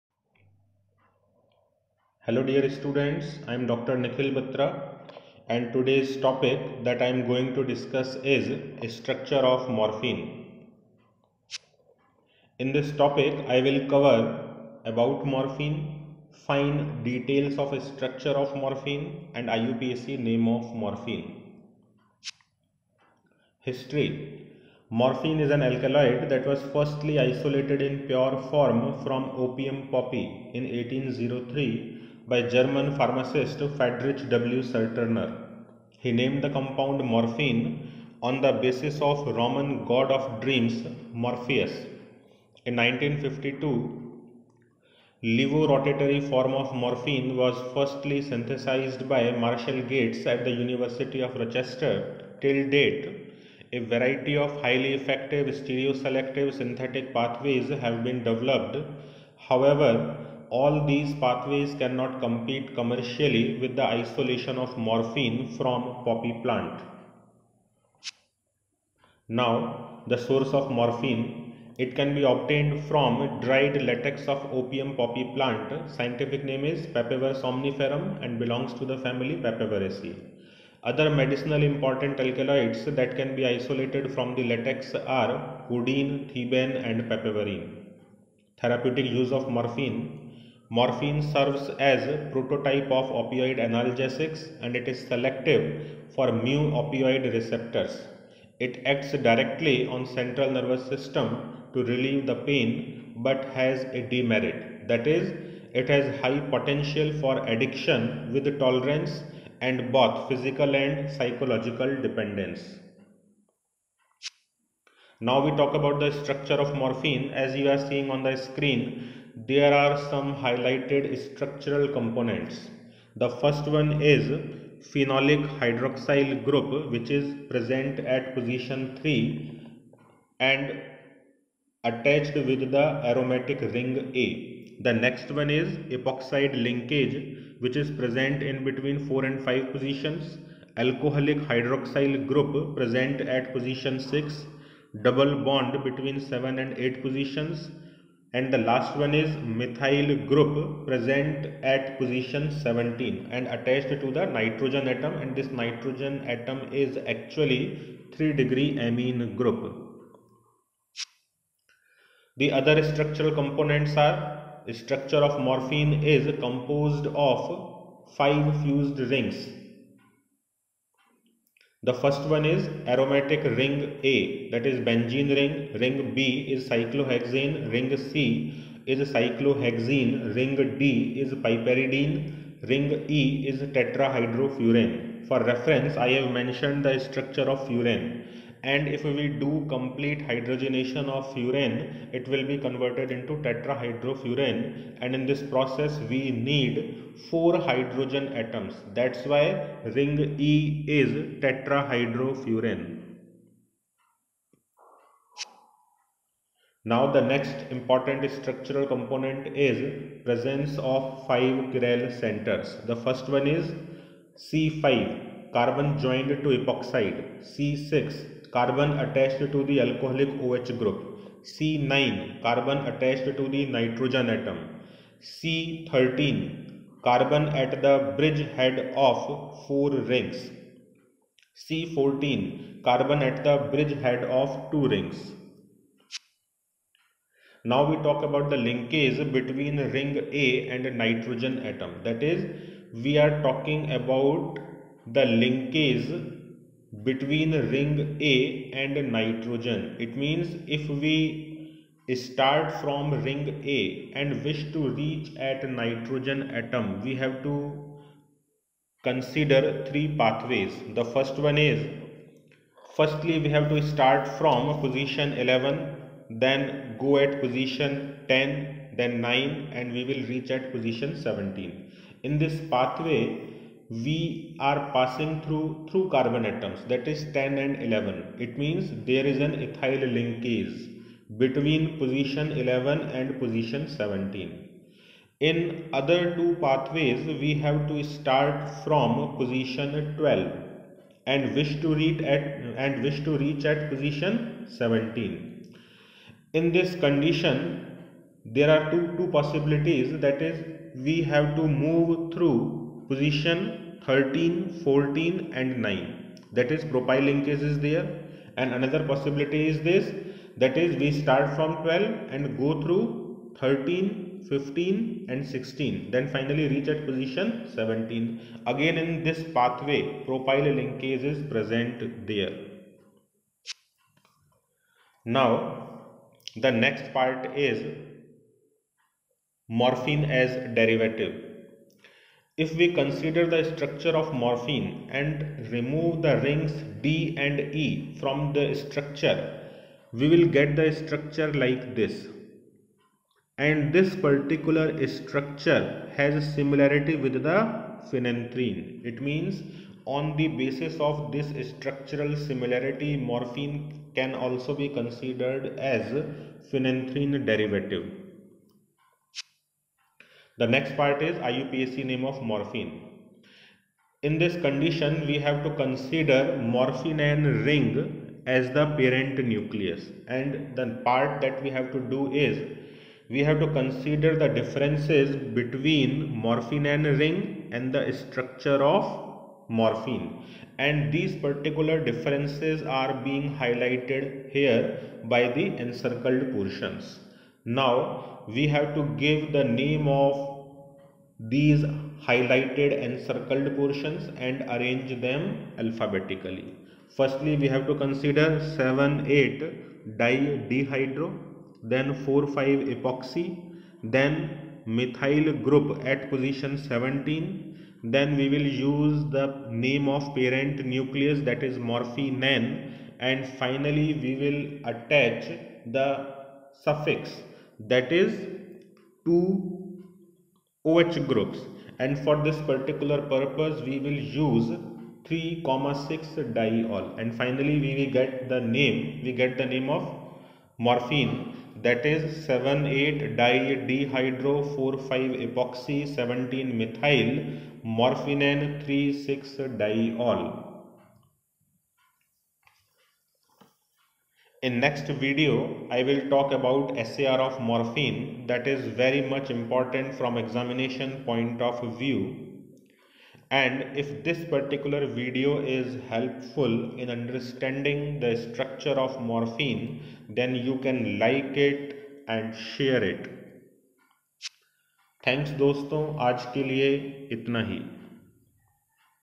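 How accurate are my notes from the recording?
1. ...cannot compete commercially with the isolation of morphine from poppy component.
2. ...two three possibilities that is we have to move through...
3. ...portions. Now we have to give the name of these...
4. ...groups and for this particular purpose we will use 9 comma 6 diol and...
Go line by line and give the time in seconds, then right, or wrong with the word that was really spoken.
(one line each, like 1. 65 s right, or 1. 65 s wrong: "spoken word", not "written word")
1. 61 s wrong: "plant", not "component"
2. 298 s wrong: "two", not "three"
3. 386 s right
4. 421 s wrong: "3", not "9".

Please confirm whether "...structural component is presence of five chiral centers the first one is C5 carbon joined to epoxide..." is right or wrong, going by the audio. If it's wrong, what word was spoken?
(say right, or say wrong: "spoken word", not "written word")
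right.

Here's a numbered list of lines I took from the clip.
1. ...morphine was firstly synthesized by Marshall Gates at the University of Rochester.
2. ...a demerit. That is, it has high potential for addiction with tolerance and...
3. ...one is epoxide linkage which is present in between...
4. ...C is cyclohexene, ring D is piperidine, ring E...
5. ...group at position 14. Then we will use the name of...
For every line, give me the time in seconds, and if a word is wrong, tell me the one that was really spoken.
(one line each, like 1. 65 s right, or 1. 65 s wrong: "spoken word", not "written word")
1. 46 s right
2. 103 s right
3. 135 s right
4. 177 s right
5. 405 s wrong: "17", not "14".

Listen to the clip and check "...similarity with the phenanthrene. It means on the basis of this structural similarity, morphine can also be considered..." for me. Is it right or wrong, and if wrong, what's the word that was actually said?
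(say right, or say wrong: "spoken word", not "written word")
right.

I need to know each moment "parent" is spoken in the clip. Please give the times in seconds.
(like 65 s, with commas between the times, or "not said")
368 s, 410 s.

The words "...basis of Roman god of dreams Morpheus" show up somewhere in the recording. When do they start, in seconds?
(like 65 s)
38 s.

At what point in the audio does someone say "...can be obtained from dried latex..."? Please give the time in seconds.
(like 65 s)
71 s.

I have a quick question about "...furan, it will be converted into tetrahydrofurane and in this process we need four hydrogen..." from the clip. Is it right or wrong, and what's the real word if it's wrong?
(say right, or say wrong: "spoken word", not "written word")
right.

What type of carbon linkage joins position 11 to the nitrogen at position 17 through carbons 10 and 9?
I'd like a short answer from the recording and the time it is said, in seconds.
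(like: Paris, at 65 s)
ethyl linkage, at 279 s.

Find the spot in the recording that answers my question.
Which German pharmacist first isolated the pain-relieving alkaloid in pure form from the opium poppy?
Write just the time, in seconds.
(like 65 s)
33 s.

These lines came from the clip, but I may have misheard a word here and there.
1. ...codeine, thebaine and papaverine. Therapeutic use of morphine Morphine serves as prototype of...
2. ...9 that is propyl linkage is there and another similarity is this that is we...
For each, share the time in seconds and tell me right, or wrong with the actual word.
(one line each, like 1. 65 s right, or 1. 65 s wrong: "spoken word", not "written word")
1. 85 s right
2. 305 s wrong: "possibility", not "similarity".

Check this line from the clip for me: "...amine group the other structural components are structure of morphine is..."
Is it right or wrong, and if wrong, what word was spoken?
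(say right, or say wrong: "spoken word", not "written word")
right.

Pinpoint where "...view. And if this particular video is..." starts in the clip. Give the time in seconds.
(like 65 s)
451 s.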